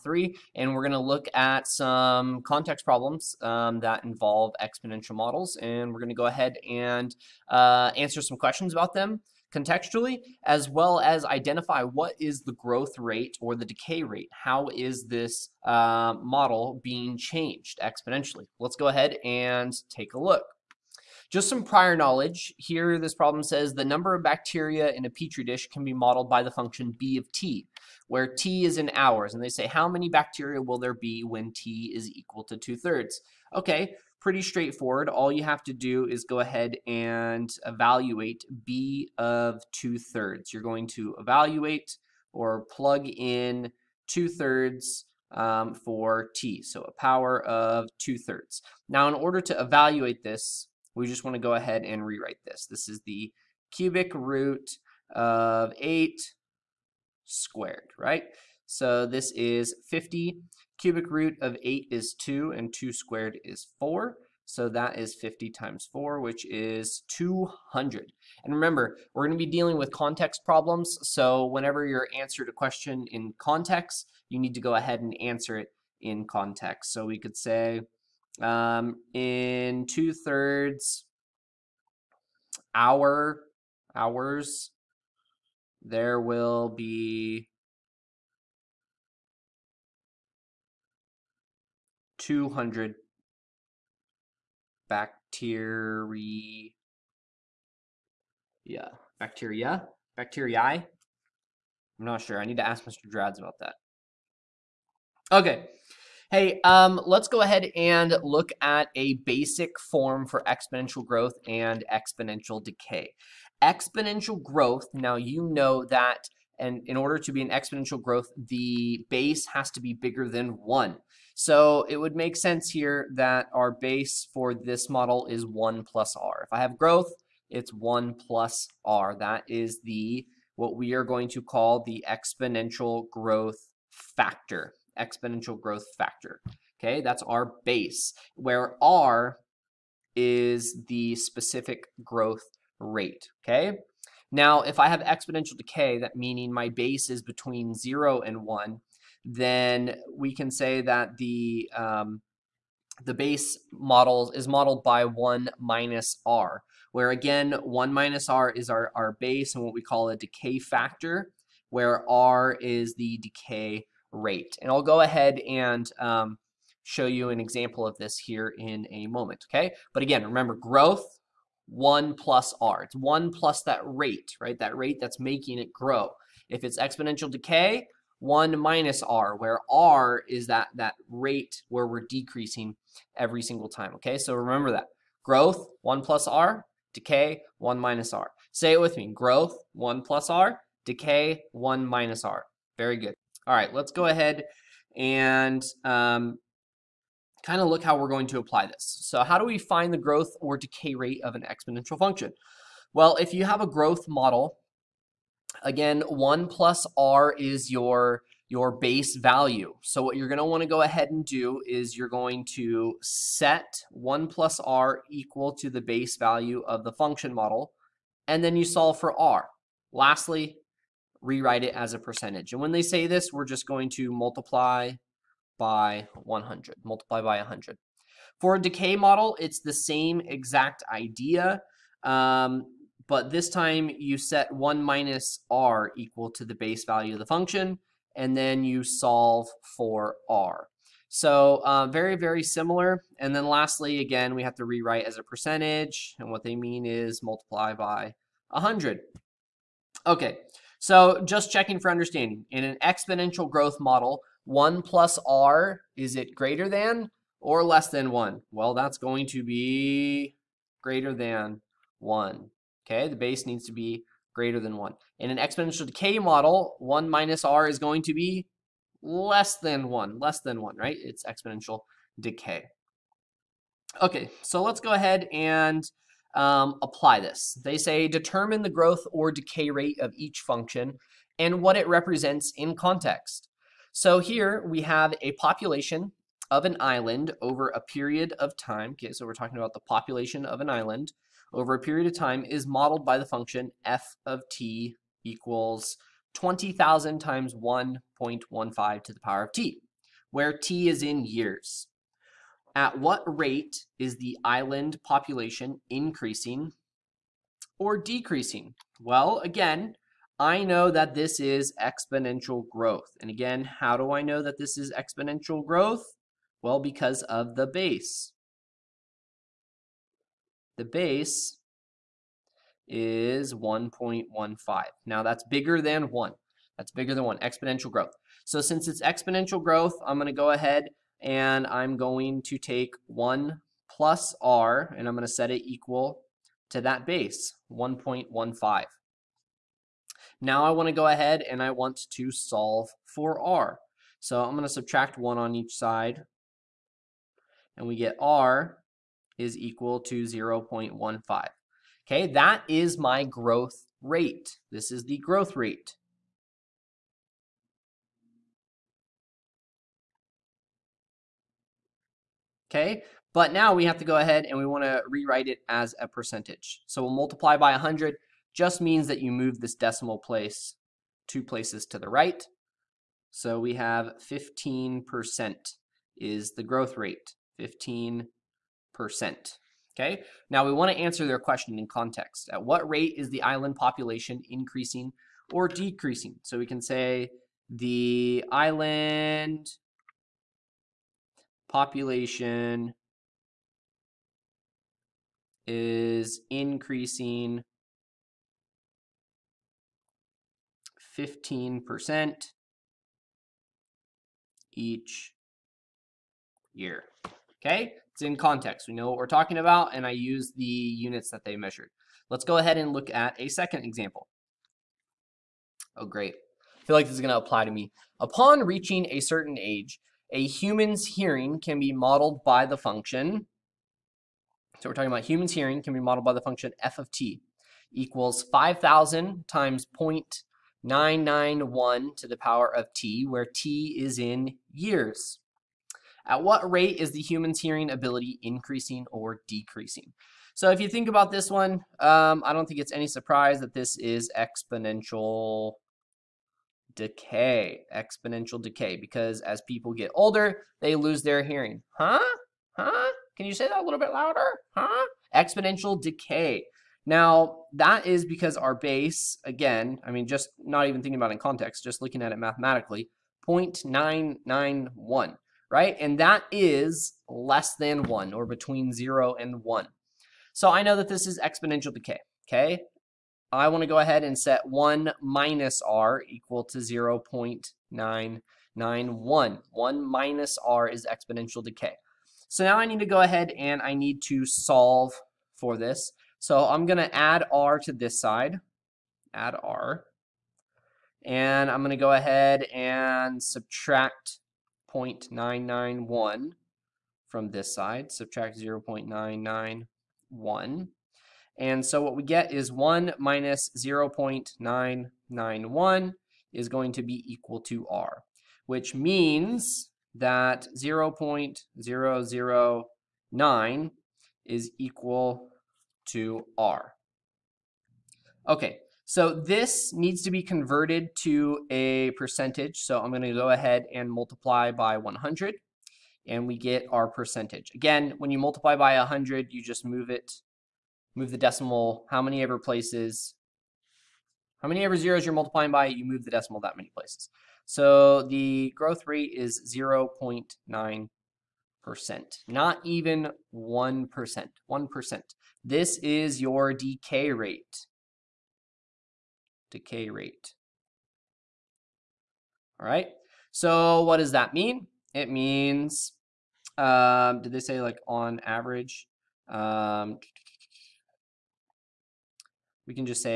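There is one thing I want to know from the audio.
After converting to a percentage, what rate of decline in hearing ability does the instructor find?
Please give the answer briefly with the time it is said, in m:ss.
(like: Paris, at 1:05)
0.9%, at 8:59.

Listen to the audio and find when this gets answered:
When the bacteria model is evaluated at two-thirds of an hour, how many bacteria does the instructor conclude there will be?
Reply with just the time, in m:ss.
1:32.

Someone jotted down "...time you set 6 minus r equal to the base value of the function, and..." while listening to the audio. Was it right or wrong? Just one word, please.
wrong.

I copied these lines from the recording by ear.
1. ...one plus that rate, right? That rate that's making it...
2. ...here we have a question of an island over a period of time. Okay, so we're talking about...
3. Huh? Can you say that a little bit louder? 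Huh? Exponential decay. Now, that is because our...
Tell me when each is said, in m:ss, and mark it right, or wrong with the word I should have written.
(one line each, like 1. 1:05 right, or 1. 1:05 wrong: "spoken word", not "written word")
1. 2:52 right
2. 4:44 wrong: "population", not "question"
3. 7:32 right.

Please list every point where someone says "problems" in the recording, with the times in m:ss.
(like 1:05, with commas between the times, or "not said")
0:02, 0:23, 1:10.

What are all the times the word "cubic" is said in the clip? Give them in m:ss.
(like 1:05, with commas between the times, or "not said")
0:53, 1:00.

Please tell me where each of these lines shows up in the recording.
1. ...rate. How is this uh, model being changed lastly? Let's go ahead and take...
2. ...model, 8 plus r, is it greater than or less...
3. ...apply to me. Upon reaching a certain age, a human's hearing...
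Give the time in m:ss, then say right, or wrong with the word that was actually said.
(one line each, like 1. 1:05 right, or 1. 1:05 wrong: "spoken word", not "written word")
1. 0:14 wrong: "exponentially", not "lastly"
2. 4:13 wrong: "1", not "8"
3. 6:57 right.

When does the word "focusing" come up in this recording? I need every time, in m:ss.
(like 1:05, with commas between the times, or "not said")
not said.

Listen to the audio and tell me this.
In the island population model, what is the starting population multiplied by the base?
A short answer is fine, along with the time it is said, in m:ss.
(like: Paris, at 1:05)
20,000, at 4:56.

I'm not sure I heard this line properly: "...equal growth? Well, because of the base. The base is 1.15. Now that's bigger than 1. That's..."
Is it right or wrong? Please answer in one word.
wrong.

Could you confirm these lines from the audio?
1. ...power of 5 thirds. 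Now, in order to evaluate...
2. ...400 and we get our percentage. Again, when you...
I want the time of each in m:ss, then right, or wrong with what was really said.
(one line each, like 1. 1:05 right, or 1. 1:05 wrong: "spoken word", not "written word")
1. 0:46 wrong: "2", not "5"
2. 8:44 wrong: "100", not "400".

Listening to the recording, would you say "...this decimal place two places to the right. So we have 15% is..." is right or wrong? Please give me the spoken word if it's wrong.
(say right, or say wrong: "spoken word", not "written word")
right.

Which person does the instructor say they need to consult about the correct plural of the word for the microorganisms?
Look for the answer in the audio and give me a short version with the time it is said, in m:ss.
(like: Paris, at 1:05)
Mr. Drads, at 1:42.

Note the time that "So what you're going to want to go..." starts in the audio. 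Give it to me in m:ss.
3:29.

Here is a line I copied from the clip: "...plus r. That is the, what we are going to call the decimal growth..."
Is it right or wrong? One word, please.
wrong.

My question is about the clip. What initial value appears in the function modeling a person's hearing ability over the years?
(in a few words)
5,000.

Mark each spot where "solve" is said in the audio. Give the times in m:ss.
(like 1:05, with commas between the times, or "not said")
3:38, 3:58, 5:42, 8:04.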